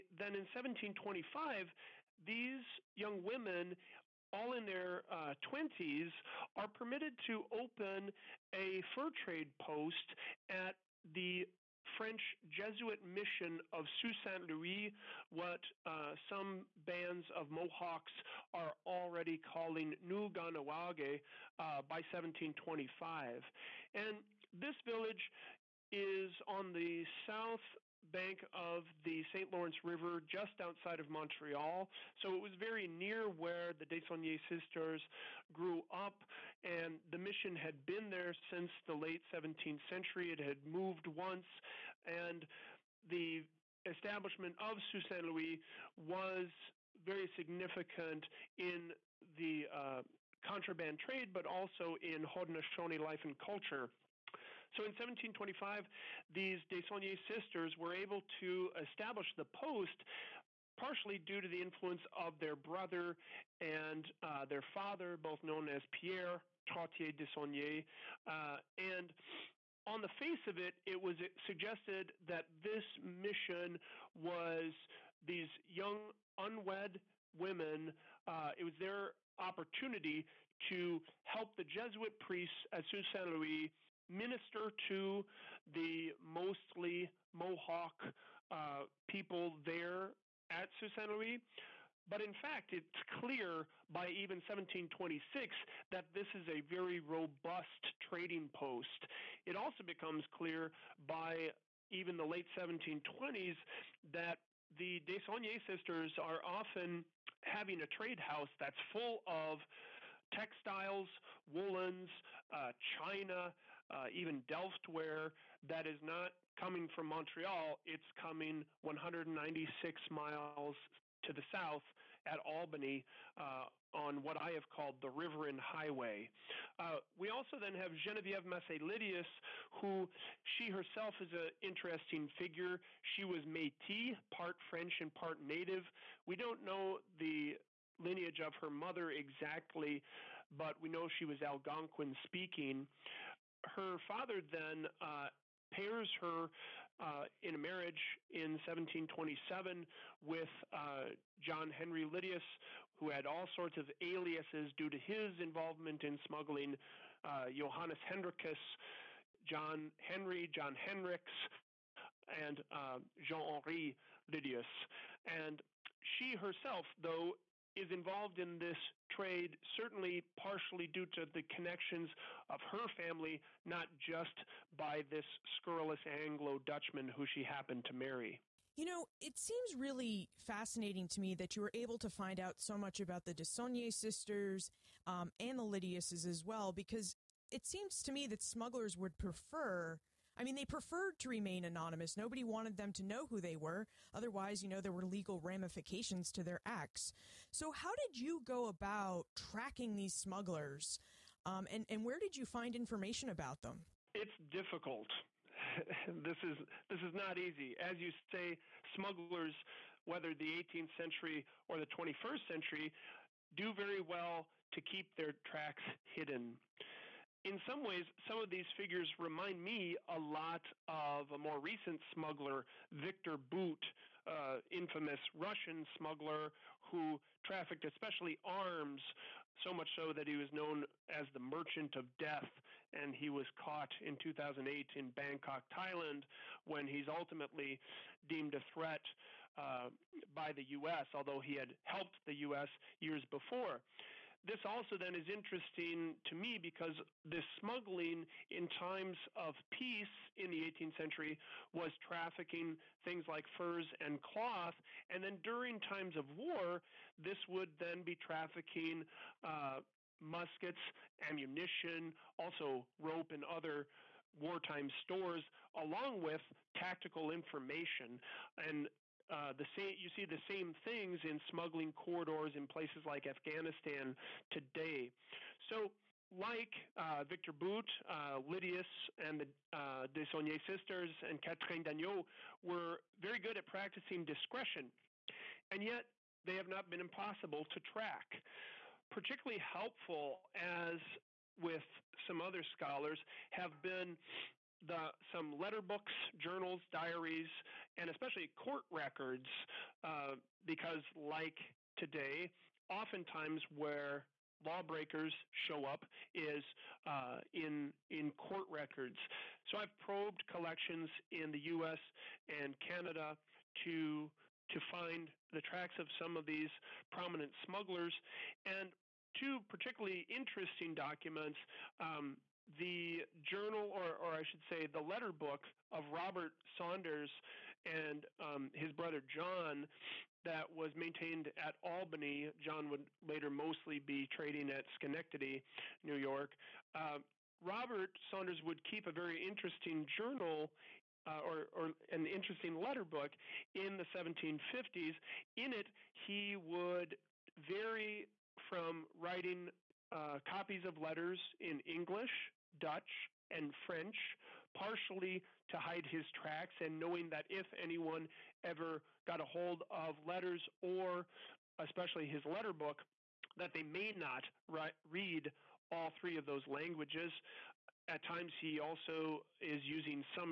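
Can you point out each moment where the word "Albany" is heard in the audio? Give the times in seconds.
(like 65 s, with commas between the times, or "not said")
122 s, 331 s.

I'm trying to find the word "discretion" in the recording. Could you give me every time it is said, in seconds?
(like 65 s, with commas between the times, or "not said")
284 s.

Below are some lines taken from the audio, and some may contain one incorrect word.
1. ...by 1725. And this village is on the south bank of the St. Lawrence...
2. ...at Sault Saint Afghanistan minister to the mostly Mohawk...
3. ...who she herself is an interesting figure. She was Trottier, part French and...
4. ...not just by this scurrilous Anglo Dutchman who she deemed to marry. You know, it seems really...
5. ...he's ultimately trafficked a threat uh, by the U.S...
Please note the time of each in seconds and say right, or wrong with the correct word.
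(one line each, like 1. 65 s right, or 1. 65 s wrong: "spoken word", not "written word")
1. 21 s right
2. 82 s wrong: "Louis", not "Afghanistan"
3. 129 s wrong: "Métis", not "Trottier"
4. 173 s wrong: "happened", not "deemed"
5. 236 s wrong: "deemed", not "trafficked".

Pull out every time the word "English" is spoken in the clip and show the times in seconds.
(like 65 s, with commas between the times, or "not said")
351 s.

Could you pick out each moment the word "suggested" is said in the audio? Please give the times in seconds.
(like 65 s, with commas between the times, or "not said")
71 s.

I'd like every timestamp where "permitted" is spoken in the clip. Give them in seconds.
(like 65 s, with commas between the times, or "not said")
6 s.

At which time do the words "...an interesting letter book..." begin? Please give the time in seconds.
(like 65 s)
342 s.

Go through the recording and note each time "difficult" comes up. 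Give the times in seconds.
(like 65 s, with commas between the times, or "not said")
204 s.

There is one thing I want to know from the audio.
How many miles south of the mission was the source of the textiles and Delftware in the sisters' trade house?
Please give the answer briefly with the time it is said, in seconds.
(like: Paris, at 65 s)
196, at 118 s.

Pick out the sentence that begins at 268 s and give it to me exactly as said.
And uh, the same you see the same things in smuggling corridors in places like Afghanistan today.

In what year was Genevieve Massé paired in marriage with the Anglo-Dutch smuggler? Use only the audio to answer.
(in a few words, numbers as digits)
1727.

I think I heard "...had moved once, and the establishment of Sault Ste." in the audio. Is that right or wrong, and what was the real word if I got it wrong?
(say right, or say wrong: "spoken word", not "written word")
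right.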